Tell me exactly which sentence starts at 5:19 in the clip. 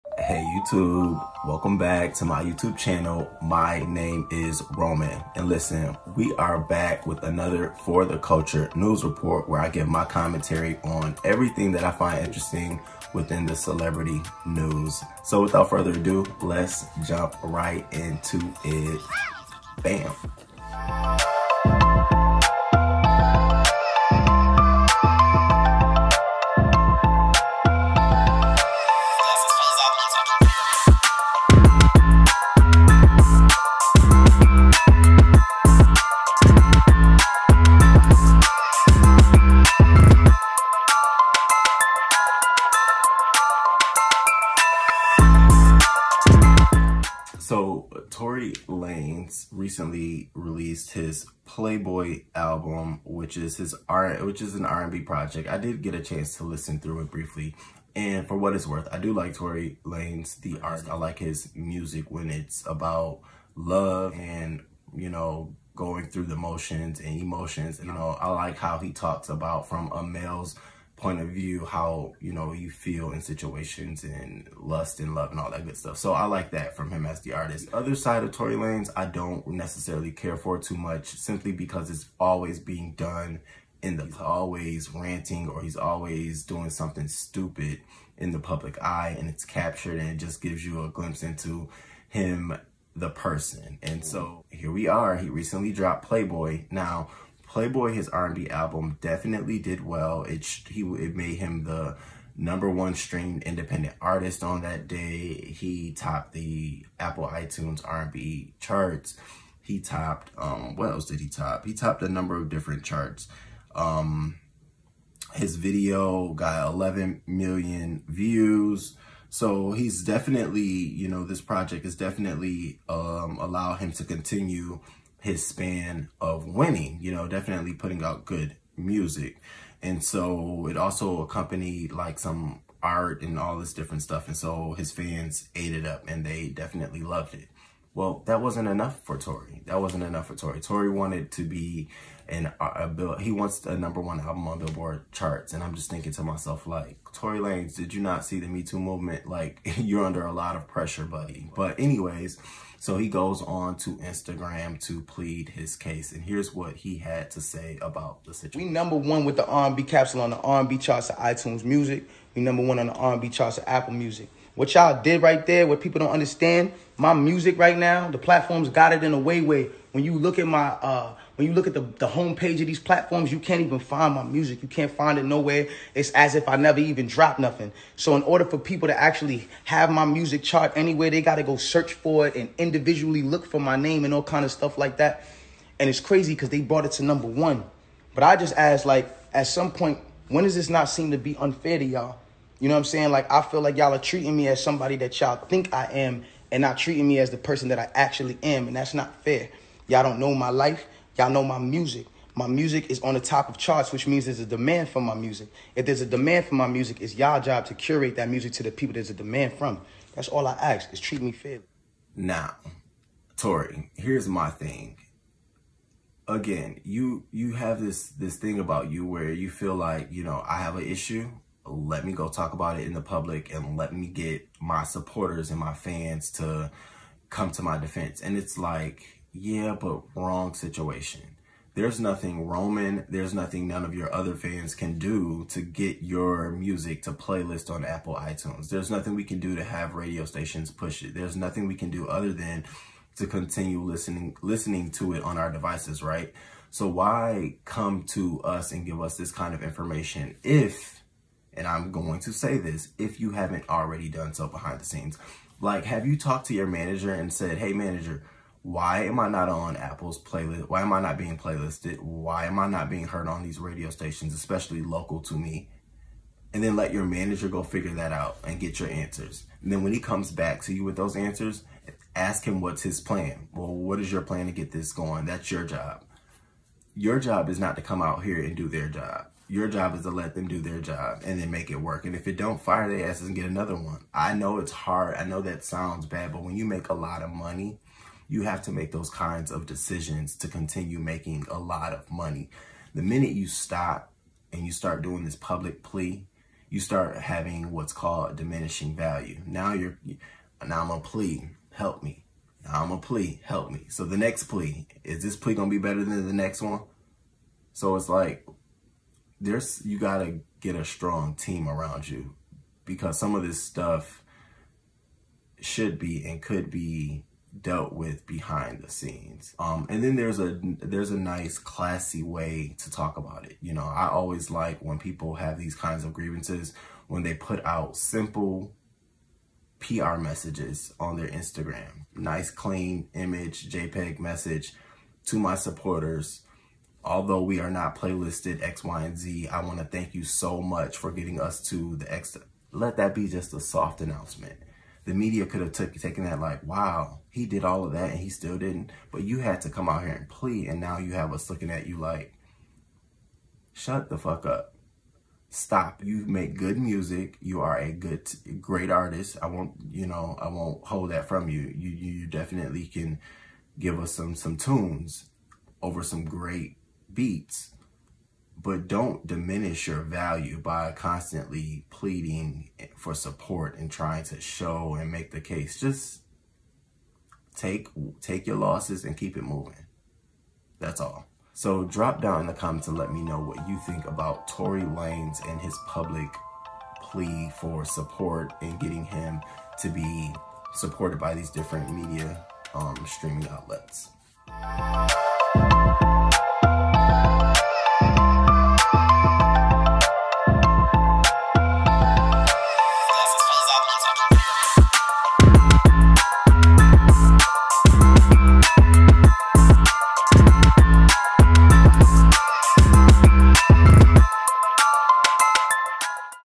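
Um, and then there's a there's a nice classy way to talk about it.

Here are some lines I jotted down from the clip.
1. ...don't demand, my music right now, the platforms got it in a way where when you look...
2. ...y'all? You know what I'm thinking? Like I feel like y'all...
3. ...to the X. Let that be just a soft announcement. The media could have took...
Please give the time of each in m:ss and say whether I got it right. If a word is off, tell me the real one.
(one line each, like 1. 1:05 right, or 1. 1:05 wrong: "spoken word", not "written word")
1. 2:45 wrong: "understand", not "demand"
2. 3:11 wrong: "saying", not "thinking"
3. 5:41 right.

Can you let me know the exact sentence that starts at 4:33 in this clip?
Well, what is your plan to get this going?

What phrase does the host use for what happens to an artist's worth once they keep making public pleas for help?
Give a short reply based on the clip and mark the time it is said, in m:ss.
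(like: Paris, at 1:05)
diminishing value, at 4:58.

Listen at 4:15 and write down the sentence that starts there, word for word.
Like, have you talked to your manager and said, hey, manager, why am I not on Apple's playlist?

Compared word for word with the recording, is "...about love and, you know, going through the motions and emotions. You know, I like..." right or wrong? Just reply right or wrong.
right.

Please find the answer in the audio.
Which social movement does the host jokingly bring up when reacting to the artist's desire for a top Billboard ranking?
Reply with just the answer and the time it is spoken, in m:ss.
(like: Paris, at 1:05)
Me Too movement, at 2:28.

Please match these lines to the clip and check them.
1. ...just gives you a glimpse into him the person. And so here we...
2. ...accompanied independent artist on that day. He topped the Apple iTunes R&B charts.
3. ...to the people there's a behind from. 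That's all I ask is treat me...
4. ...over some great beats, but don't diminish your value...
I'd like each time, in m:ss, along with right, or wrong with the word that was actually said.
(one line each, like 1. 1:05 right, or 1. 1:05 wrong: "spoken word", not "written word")
1. 1:30 right
2. 1:42 wrong: "streamed", not "accompanied"
3. 3:28 wrong: "demand", not "behind"
4. 6:05 right.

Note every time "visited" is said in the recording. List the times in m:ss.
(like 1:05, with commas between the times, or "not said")
not said.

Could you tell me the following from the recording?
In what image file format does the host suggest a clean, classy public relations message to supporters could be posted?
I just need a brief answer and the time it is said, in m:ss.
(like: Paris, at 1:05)
JPEG, at 5:33.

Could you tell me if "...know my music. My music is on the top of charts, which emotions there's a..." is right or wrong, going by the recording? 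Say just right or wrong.
wrong.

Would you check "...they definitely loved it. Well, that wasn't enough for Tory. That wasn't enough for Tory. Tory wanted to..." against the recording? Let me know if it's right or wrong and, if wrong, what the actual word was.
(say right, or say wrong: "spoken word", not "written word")
right.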